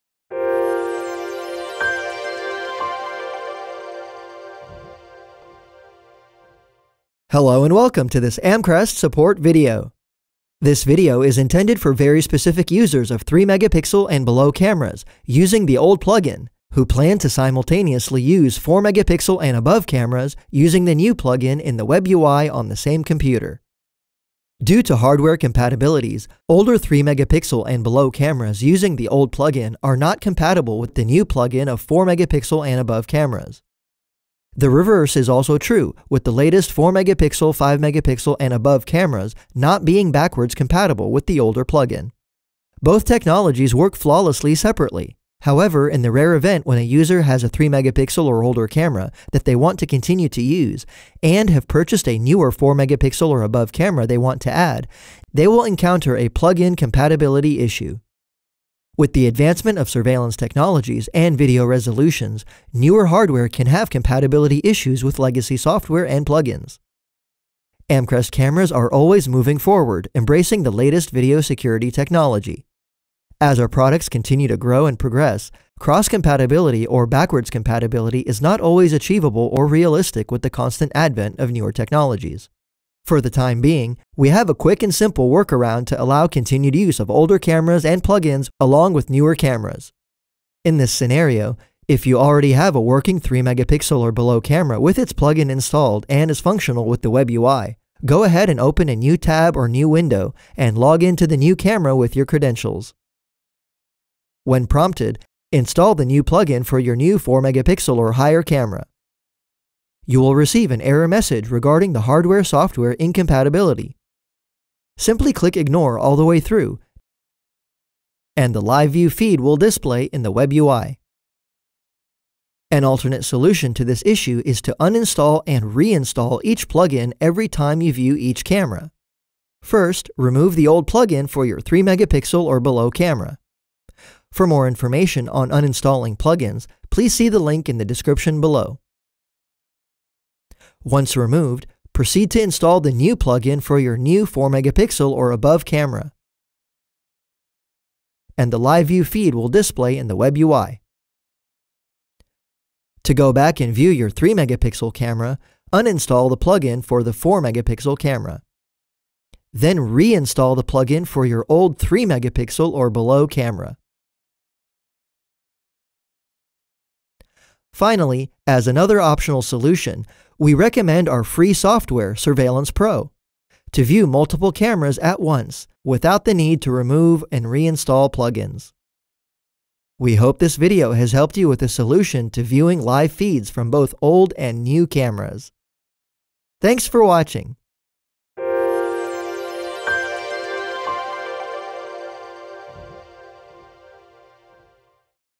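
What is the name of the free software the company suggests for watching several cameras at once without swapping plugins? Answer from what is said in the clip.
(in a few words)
Surveillance Pro.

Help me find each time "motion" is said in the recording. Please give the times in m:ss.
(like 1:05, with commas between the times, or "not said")
not said.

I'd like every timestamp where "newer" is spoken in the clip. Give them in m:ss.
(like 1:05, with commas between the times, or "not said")
0:52, 1:02, 1:21, 1:29.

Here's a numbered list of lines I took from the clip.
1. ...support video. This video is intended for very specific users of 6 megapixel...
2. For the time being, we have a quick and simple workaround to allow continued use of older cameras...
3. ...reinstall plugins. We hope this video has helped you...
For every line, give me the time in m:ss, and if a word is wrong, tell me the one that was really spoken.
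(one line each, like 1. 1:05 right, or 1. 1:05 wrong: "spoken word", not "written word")
1. 0:08 wrong: "3", not "6"
2. 1:23 right
3. 2:57 right.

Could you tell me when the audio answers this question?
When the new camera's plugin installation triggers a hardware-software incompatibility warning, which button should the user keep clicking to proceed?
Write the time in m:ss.
1:55.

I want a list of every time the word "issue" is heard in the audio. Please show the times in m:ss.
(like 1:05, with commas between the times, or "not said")
0:57, 1:04, 2:04.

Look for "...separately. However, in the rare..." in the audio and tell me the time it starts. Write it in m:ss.
0:44.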